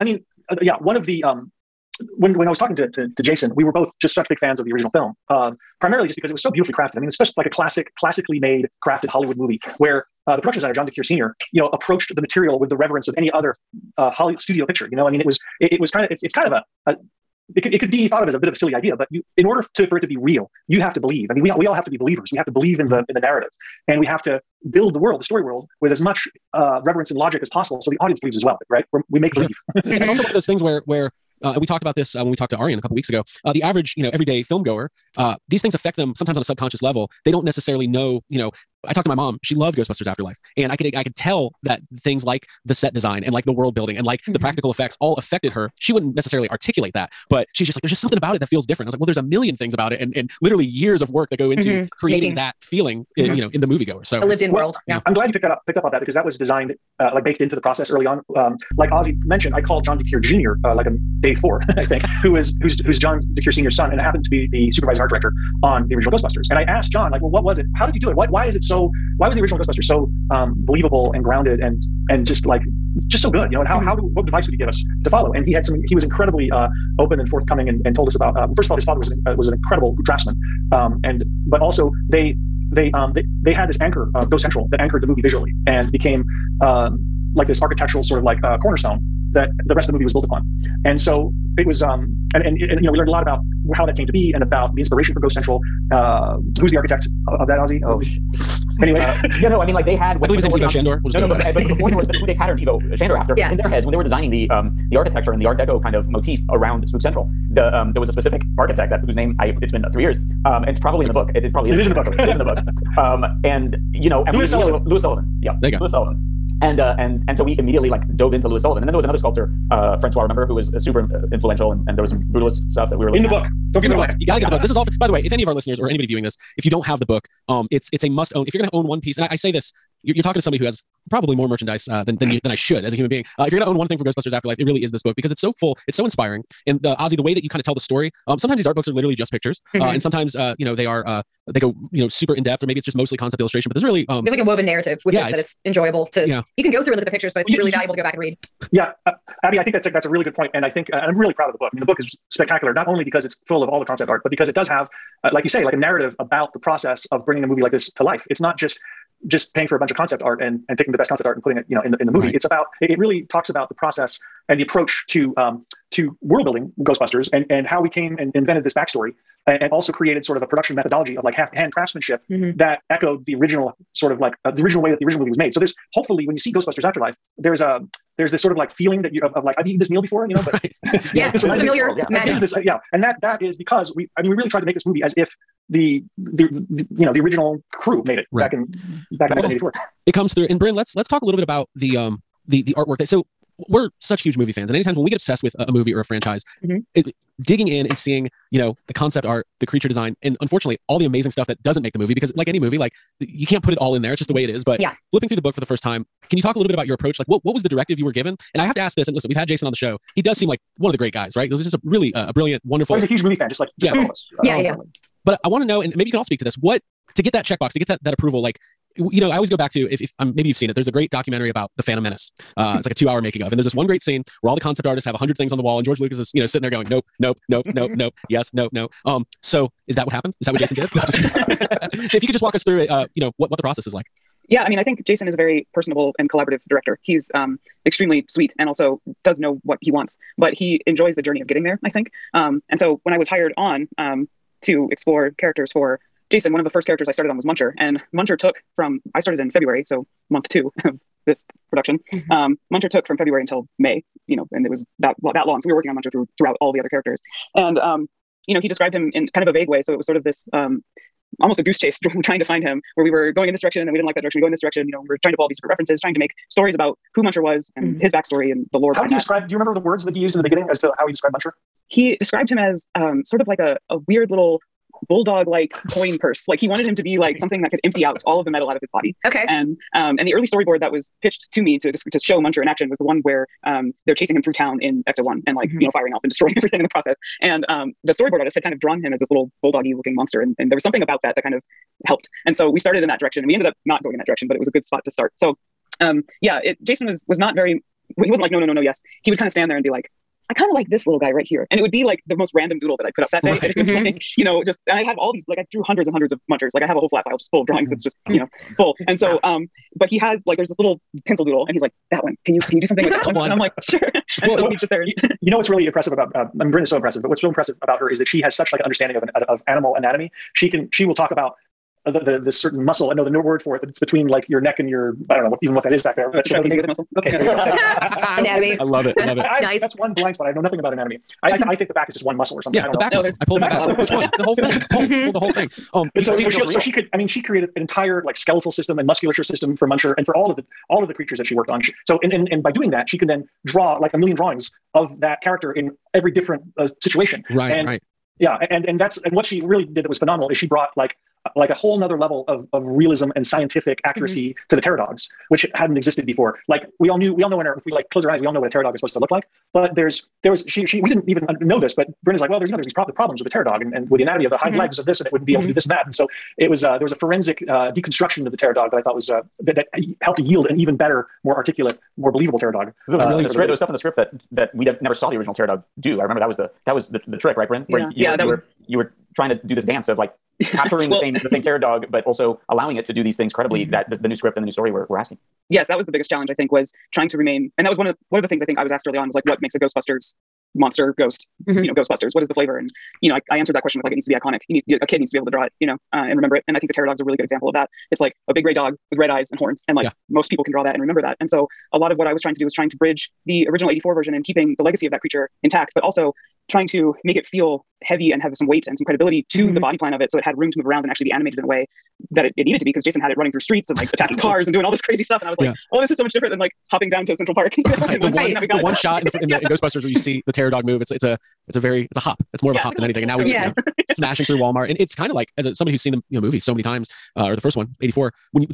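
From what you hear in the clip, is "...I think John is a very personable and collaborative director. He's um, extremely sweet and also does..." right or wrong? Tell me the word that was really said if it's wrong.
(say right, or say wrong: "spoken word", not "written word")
wrong: "Jason", not "John".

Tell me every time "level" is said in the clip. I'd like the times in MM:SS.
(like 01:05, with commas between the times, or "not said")
00:36, 05:52.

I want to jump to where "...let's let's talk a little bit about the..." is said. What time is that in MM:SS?
03:10.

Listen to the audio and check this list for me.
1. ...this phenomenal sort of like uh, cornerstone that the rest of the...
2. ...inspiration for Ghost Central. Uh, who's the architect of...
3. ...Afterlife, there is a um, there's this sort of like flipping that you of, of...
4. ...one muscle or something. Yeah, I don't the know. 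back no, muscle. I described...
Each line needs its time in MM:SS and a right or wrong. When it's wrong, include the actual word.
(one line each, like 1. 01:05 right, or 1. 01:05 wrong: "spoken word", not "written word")
1. 01:27 wrong: "architectural", not "phenomenal"
2. 01:34 right
3. 02:56 wrong: "feeling", not "flipping"
4. 05:32 wrong: "pulled", not "described".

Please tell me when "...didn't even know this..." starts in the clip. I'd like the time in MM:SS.
06:01.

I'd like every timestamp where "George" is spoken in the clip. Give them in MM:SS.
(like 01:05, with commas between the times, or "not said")
03:45.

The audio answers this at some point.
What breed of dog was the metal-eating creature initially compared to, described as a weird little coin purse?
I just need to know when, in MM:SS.
04:35.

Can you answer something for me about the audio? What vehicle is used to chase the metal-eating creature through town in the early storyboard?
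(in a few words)
Ecto One.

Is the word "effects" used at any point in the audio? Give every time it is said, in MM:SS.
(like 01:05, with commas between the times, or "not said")
00:44.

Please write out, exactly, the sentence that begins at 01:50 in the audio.
Um, and it's probably it's in okay.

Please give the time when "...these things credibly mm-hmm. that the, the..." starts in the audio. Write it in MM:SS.
06:23.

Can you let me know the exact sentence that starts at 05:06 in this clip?
Like, I have a whole flat file just full of drawings mm-hmm.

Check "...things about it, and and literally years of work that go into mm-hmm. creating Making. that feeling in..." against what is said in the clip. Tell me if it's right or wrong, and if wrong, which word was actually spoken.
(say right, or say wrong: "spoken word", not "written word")
right.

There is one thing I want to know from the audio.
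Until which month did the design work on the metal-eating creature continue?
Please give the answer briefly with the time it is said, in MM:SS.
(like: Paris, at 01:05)
May, at 04:13.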